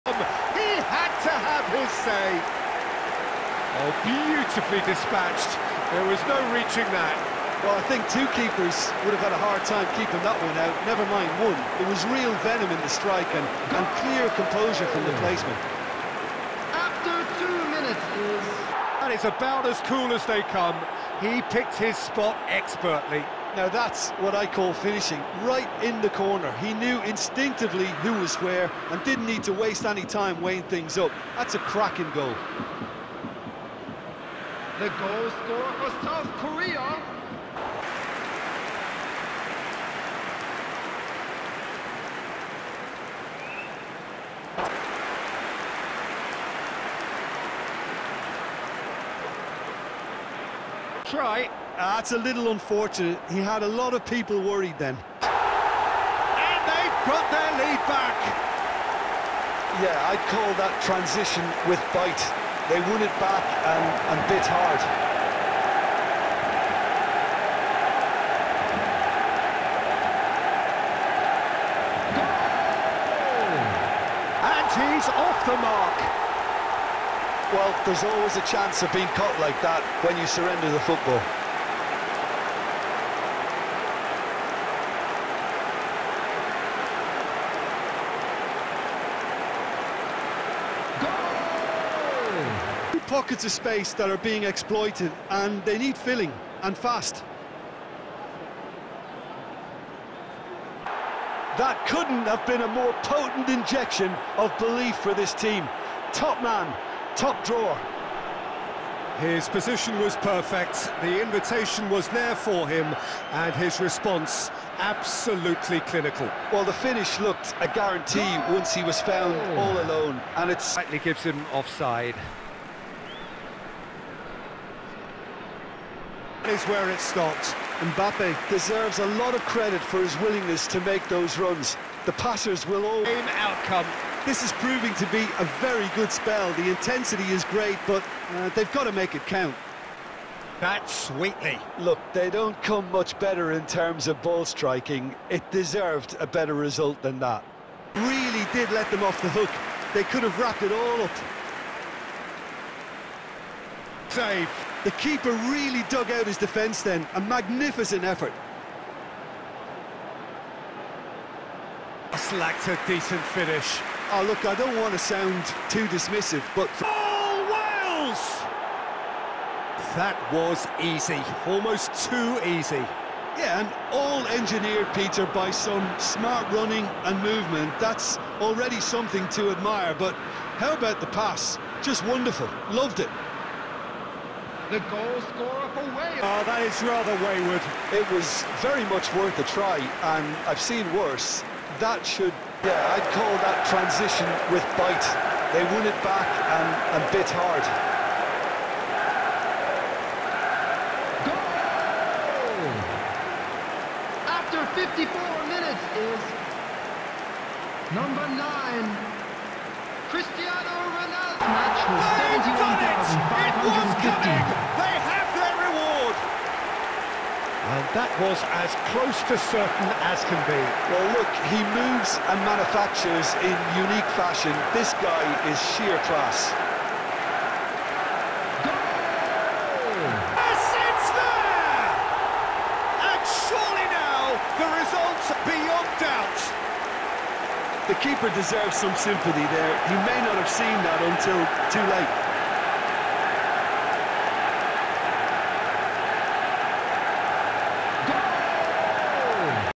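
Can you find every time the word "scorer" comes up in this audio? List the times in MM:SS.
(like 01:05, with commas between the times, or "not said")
00:35, 03:05.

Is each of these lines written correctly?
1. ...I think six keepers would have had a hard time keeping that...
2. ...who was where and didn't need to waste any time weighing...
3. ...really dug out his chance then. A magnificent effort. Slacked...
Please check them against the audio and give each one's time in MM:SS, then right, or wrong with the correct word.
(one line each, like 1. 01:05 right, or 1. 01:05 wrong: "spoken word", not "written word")
1. 00:07 wrong: "two", not "six"
2. 00:27 right
3. 02:35 wrong: "defence", not "chance".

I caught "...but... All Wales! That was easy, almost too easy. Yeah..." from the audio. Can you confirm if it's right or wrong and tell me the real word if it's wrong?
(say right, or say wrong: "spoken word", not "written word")
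right.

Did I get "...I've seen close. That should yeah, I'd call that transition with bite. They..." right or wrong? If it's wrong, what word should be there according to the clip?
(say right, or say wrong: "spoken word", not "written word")
wrong: "worse", not "close".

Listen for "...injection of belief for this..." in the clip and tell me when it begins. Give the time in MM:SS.
01:43.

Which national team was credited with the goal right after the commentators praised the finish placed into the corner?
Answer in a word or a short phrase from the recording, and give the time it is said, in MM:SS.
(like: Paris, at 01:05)
South Korea, at 00:36.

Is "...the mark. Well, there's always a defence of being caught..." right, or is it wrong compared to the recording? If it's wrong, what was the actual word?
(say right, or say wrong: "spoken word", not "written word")
wrong: "chance", not "defence".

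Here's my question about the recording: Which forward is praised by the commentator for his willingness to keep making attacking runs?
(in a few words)
Mbappe.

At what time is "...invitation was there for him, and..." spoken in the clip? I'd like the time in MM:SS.
01:51.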